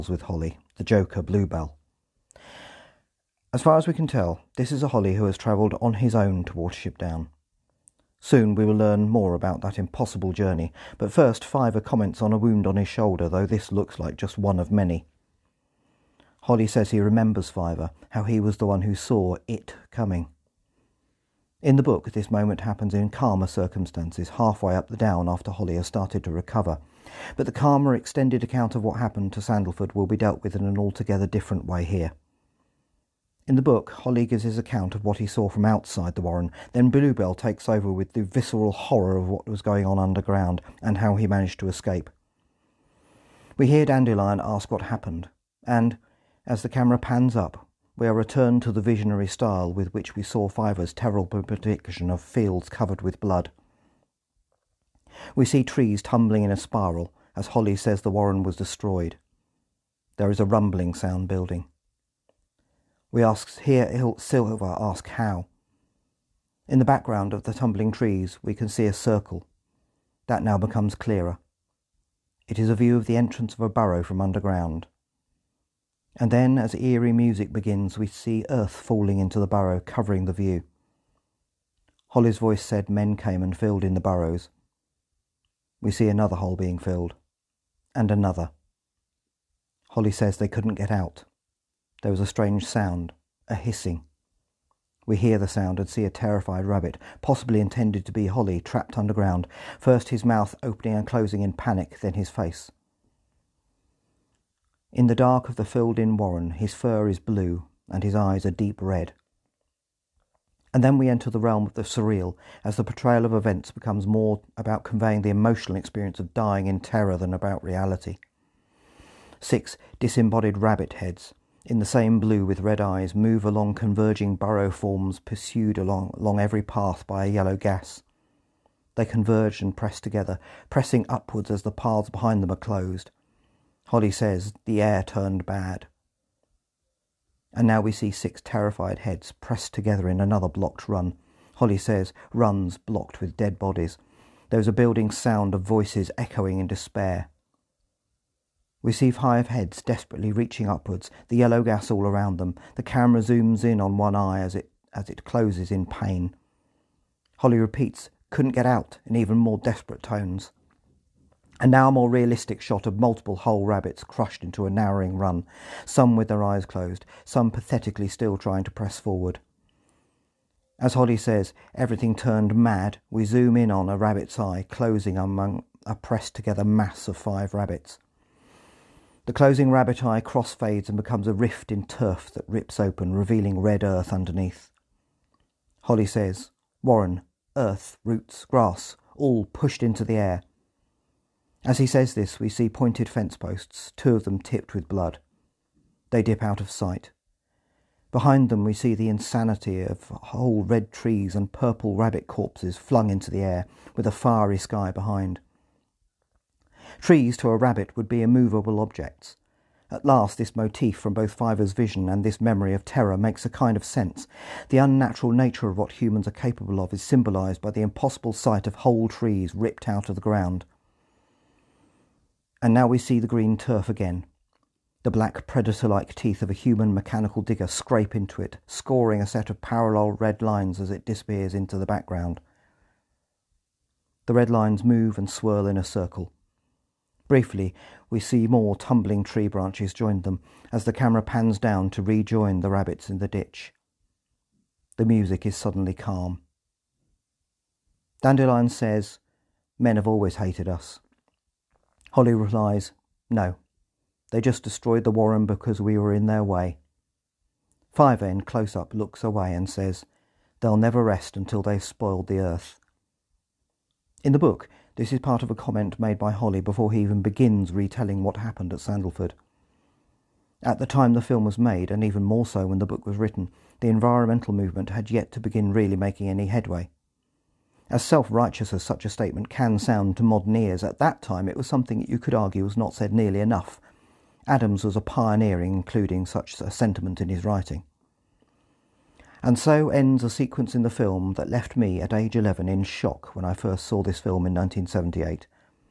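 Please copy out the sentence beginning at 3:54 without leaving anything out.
The red lines move and swirl in a circle.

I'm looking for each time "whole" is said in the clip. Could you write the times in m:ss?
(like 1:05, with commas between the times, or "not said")
2:43, 3:20, 3:38.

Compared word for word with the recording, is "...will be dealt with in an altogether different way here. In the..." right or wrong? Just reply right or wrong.
right.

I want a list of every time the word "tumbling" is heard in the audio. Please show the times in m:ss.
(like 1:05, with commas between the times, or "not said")
0:56, 1:07, 3:58.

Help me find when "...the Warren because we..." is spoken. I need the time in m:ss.
4:15.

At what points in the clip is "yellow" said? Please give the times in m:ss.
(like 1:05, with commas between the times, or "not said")
2:07, 2:31.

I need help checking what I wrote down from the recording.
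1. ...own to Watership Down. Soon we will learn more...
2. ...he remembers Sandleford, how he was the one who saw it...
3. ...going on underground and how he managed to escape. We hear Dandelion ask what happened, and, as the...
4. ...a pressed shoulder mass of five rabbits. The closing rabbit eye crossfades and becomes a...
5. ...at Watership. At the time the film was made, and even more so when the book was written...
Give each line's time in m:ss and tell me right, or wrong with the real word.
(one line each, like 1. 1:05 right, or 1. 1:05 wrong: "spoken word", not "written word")
1. 0:06 right
2. 0:16 wrong: "Fiver", not "Sandleford"
3. 0:39 right
4. 2:55 wrong: "together", not "shoulder"
5. 4:28 wrong: "Sandleford", not "Watership".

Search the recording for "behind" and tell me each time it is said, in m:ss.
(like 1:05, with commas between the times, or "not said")
2:12, 3:18, 3:24.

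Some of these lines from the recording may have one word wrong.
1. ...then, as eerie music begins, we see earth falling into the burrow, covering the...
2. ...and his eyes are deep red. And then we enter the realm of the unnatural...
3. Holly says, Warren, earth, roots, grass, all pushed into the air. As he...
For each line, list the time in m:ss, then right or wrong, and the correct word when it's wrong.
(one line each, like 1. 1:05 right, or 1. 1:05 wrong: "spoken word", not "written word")
1. 1:16 right
2. 1:47 wrong: "surreal", not "unnatural"
3. 3:05 right.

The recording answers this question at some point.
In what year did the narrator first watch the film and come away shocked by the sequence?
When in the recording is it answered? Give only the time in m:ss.
4:54.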